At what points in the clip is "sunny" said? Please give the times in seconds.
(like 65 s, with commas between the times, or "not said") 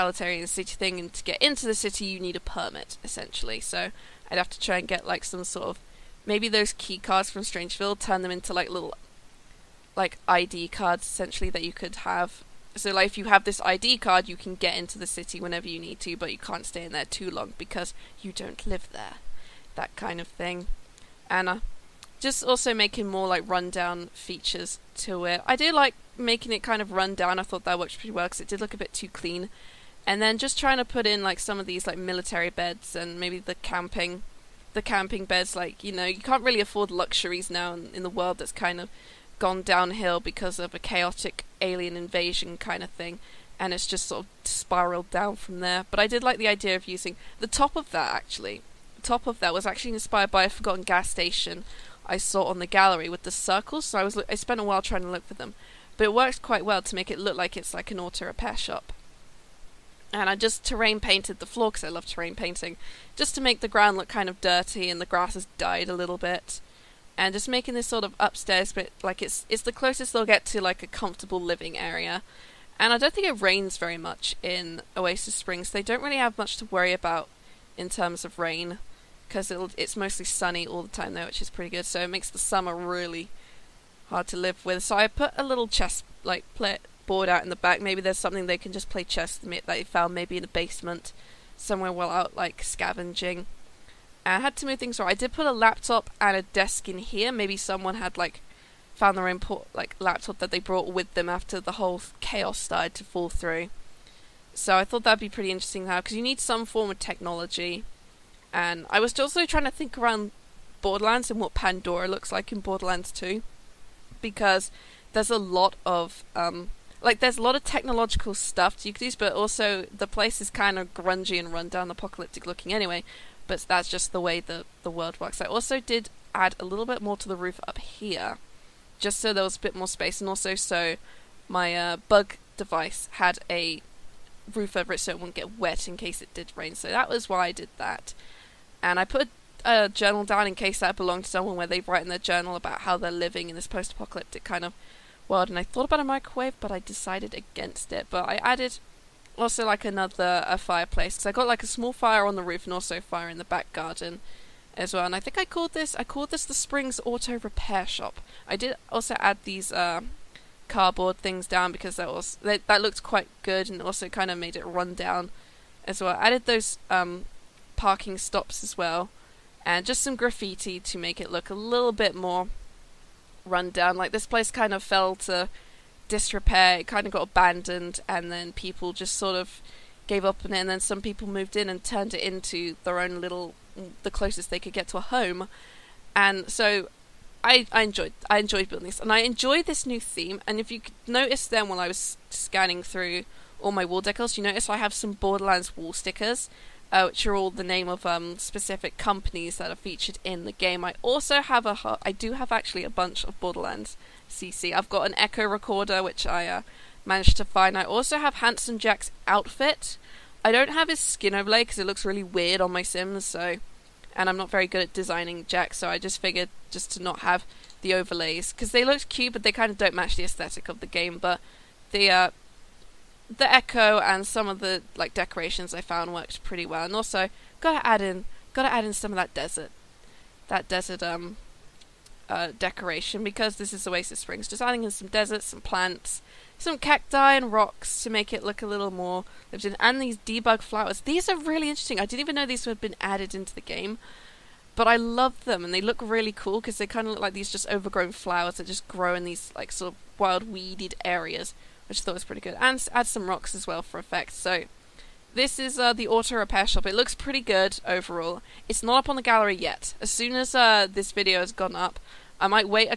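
80 s.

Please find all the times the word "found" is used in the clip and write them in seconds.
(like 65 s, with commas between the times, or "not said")
89 s, 98 s, 225 s.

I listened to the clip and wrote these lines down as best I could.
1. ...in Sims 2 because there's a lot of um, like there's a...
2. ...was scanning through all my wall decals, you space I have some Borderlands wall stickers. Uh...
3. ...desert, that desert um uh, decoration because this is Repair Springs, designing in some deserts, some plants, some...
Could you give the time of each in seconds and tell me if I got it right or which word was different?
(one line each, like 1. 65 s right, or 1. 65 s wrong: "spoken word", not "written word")
1. 112 s wrong: "Borderlands", not "Sims"
2. 191 s wrong: "notice", not "space"
3. 229 s wrong: "Oasis", not "Repair".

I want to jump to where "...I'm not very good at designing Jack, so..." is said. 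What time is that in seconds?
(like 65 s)
214 s.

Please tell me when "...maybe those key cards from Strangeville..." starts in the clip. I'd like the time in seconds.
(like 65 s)
6 s.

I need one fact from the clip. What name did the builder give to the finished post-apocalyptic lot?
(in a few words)
Springs Auto Repair Shop.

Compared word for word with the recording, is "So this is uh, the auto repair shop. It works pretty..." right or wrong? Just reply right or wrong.
wrong.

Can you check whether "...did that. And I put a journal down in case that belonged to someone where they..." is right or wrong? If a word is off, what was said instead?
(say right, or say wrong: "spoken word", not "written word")
right.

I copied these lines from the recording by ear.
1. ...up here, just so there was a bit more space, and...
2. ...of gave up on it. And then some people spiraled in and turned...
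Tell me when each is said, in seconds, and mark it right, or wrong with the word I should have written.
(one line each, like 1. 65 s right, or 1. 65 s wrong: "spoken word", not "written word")
1. 127 s right
2. 179 s wrong: "moved", not "spiraled".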